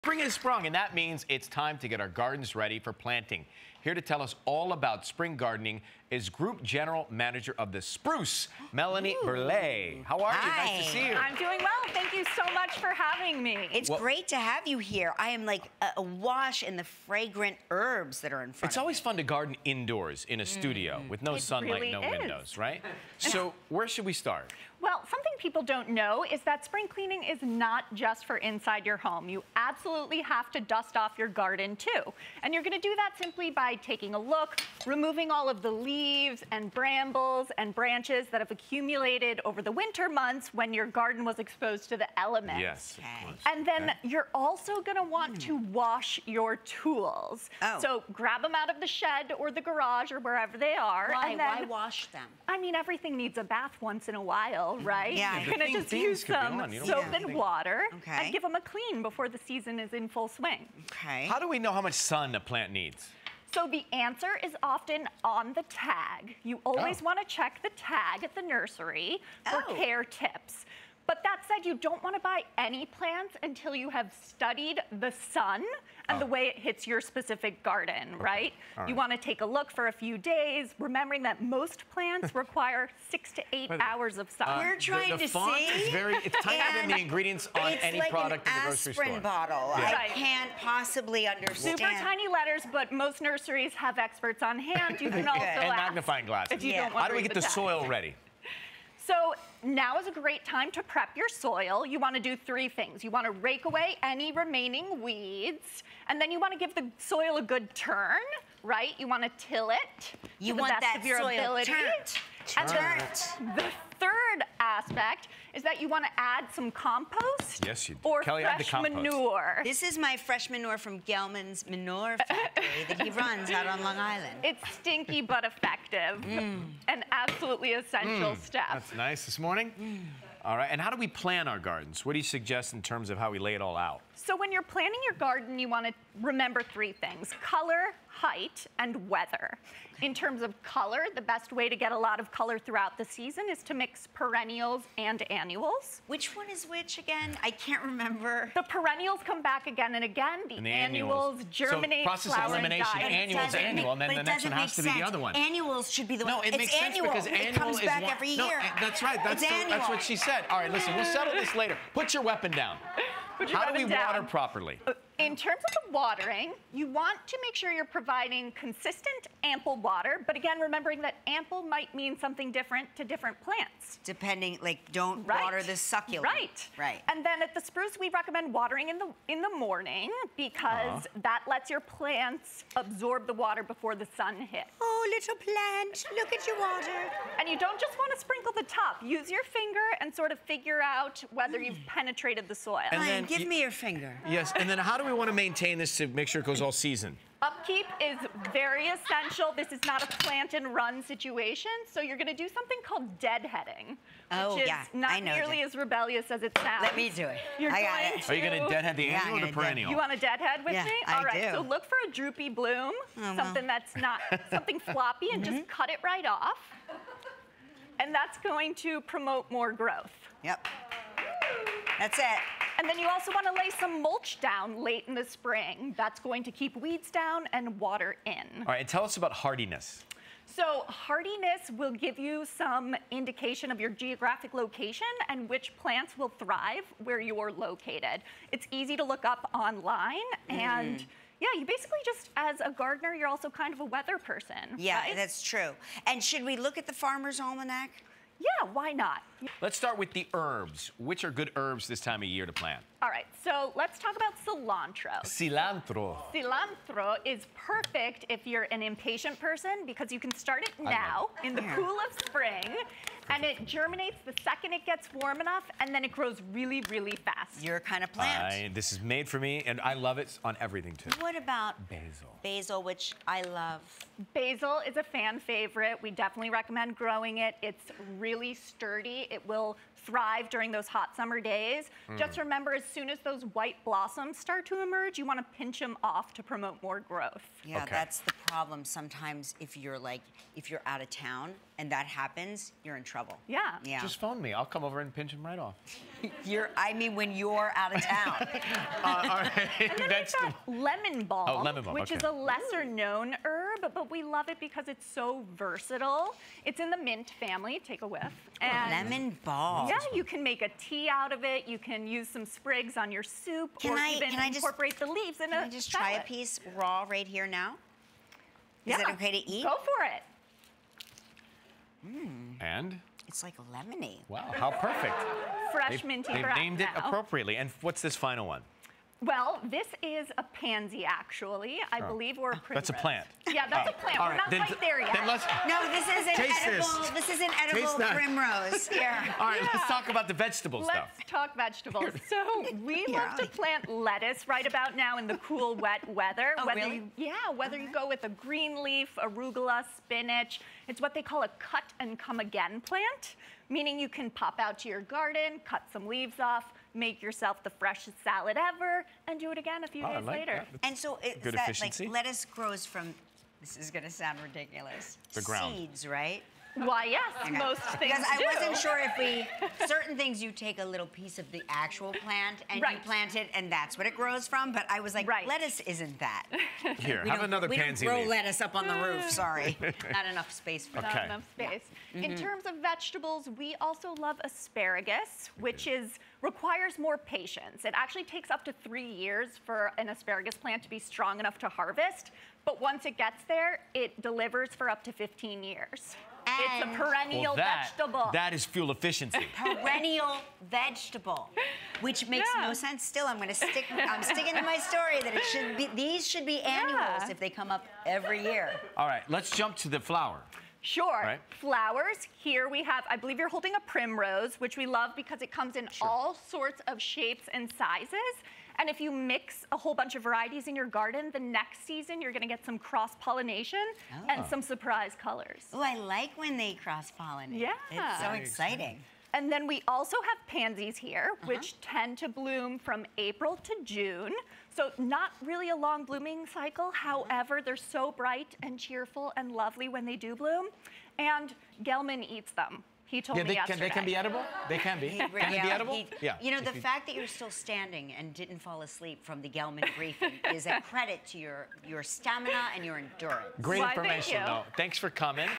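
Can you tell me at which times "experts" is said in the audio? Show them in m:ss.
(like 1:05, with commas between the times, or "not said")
1:33.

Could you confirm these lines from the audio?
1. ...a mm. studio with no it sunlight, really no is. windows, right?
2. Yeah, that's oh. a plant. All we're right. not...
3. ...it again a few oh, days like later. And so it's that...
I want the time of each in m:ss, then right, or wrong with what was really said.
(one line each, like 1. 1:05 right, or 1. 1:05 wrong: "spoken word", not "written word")
1. 0:20 right
2. 5:33 right
3. 5:59 right.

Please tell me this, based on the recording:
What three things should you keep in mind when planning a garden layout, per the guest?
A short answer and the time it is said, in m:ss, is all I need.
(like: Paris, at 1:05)
color, height, and weather, at 2:17.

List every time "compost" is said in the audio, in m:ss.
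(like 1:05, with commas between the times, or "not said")
1:56.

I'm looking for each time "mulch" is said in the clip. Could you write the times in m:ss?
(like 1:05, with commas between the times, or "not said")
3:44.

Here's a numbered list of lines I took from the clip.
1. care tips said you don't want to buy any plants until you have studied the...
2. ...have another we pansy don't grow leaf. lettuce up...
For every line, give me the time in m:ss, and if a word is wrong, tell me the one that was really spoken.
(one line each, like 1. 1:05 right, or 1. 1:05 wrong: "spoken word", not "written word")
1. 1:09 right
2. 6:17 right.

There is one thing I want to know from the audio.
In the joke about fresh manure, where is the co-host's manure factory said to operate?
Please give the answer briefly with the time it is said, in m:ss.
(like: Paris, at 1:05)
Long Island, at 2:03.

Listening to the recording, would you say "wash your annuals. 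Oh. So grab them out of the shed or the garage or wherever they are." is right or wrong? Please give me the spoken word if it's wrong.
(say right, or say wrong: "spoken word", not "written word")
wrong: "tools", not "annuals".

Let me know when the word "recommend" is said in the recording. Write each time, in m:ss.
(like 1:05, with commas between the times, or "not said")
2:58, 4:36.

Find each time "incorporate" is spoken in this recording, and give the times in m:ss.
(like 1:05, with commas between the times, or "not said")
5:14.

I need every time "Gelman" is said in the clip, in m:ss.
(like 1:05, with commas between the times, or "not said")
2:01, 7:21, 7:29.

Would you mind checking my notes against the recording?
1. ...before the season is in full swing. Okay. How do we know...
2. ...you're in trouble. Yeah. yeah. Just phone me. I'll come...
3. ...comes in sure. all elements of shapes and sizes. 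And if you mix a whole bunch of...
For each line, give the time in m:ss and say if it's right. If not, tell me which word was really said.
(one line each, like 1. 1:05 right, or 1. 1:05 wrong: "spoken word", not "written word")
1. 0:59 right
2. 4:52 right
3. 6:55 wrong: "sorts", not "elements".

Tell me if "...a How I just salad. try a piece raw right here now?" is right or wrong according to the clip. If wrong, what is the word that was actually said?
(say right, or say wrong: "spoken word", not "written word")
wrong: "Can", not "How".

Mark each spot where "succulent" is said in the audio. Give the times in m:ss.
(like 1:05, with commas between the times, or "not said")
2:55.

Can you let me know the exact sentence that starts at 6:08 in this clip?
wasn't sure if we, certain things you take a little piece of the actual plant and right.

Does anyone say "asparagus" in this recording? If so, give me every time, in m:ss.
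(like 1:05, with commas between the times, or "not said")
6:24, 6:30.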